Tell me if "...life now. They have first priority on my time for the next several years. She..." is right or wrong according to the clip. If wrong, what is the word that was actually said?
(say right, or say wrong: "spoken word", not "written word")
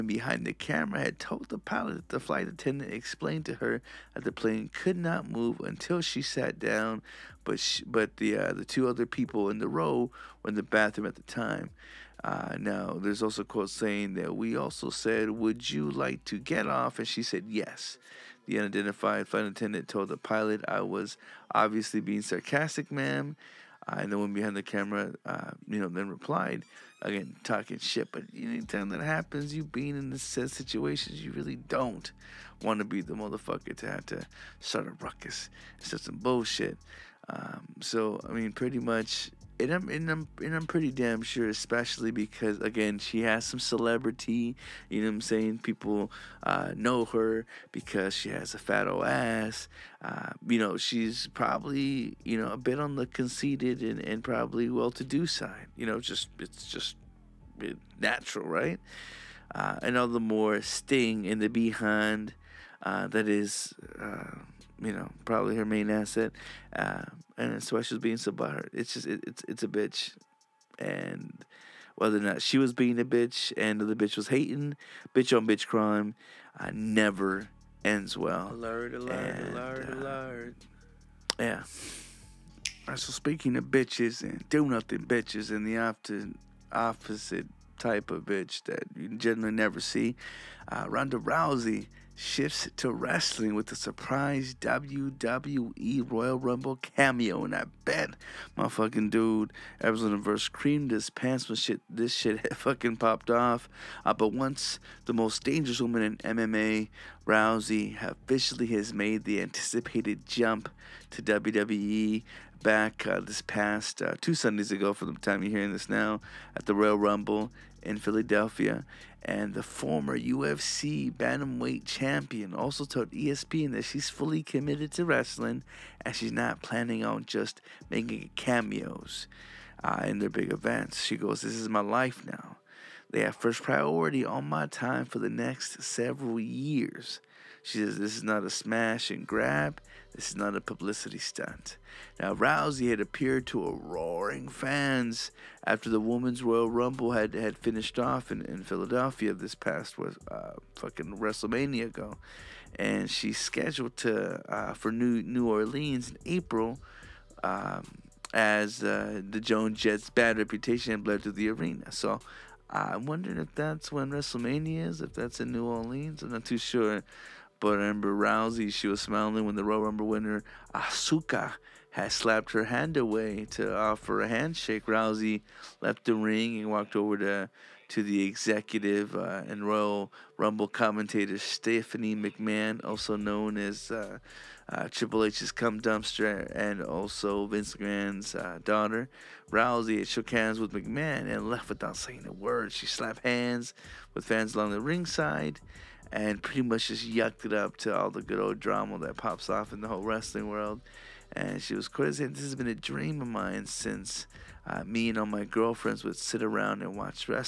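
right.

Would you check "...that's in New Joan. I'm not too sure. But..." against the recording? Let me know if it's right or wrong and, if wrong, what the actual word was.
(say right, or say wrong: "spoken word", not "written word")
wrong: "Orleans", not "Joan".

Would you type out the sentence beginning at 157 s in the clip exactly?
Um, as uh, the Joan Jett's bad reputation bled to the arena.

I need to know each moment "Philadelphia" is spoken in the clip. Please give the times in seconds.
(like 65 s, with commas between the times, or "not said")
117 s, 148 s.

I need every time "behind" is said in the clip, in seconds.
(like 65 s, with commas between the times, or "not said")
0 s, 24 s, 61 s.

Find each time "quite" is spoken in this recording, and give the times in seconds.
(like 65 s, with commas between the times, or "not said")
201 s.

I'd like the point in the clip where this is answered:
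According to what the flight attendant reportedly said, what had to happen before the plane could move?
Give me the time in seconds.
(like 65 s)
6 s.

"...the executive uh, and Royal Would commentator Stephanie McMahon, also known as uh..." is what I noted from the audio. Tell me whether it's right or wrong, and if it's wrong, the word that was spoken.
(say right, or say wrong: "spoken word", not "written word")
wrong: "Rumble", not "Would".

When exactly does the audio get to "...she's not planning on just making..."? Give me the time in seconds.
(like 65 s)
126 s.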